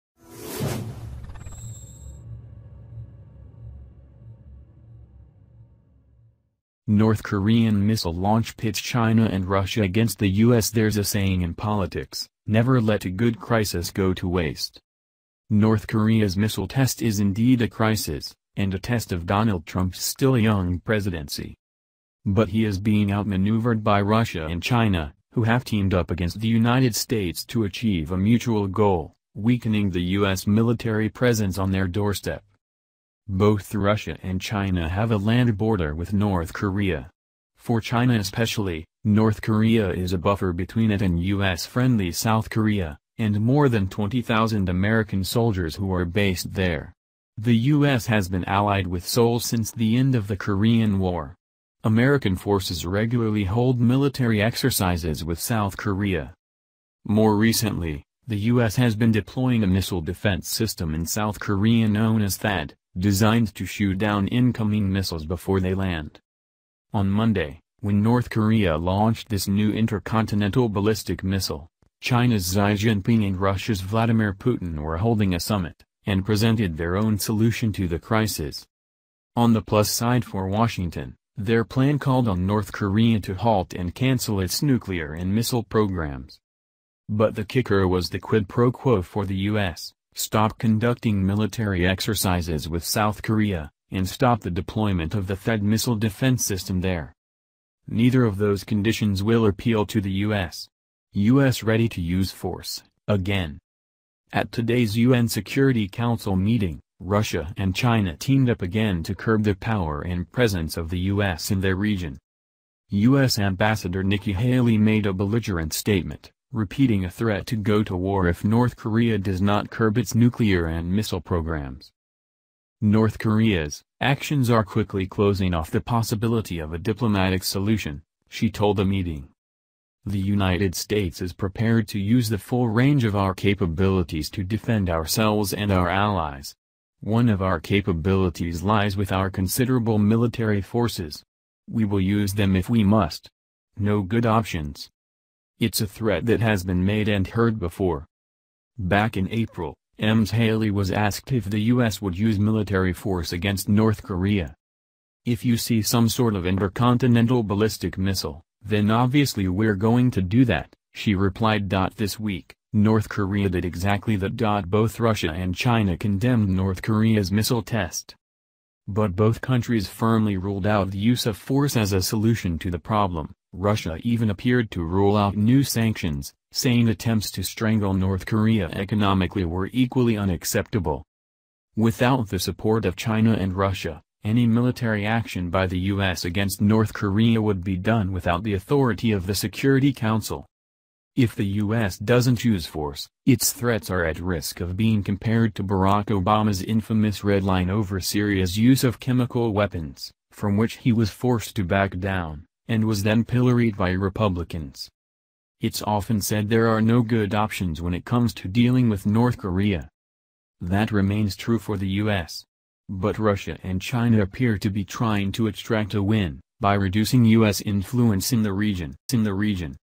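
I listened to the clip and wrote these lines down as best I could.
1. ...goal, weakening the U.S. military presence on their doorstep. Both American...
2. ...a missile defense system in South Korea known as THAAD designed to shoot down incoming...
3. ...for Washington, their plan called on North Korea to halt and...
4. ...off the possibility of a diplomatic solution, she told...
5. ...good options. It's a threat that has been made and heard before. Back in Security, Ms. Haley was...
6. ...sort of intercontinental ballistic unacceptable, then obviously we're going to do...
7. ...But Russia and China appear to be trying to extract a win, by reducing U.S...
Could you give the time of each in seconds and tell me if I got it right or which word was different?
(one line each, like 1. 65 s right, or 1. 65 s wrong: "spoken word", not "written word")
1. 28 s wrong: "Russia", not "American"
2. 59 s right
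3. 80 s right
4. 125 s right
5. 144 s wrong: "April", not "Security"
6. 156 s wrong: "missile", not "unacceptable"
7. 212 s right.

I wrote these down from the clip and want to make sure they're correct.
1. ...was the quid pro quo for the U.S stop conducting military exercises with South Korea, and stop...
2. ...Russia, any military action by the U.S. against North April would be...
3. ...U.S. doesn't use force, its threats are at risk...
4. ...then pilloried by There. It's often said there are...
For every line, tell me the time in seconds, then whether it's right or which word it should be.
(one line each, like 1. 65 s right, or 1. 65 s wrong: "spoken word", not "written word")
1. 87 s right
2. 183 s wrong: "Korea", not "April"
3. 191 s right
4. 203 s wrong: "Republicans", not "There".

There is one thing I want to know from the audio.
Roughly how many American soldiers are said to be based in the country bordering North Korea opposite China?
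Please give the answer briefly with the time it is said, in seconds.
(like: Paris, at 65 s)
more than 20,000, at 43 s.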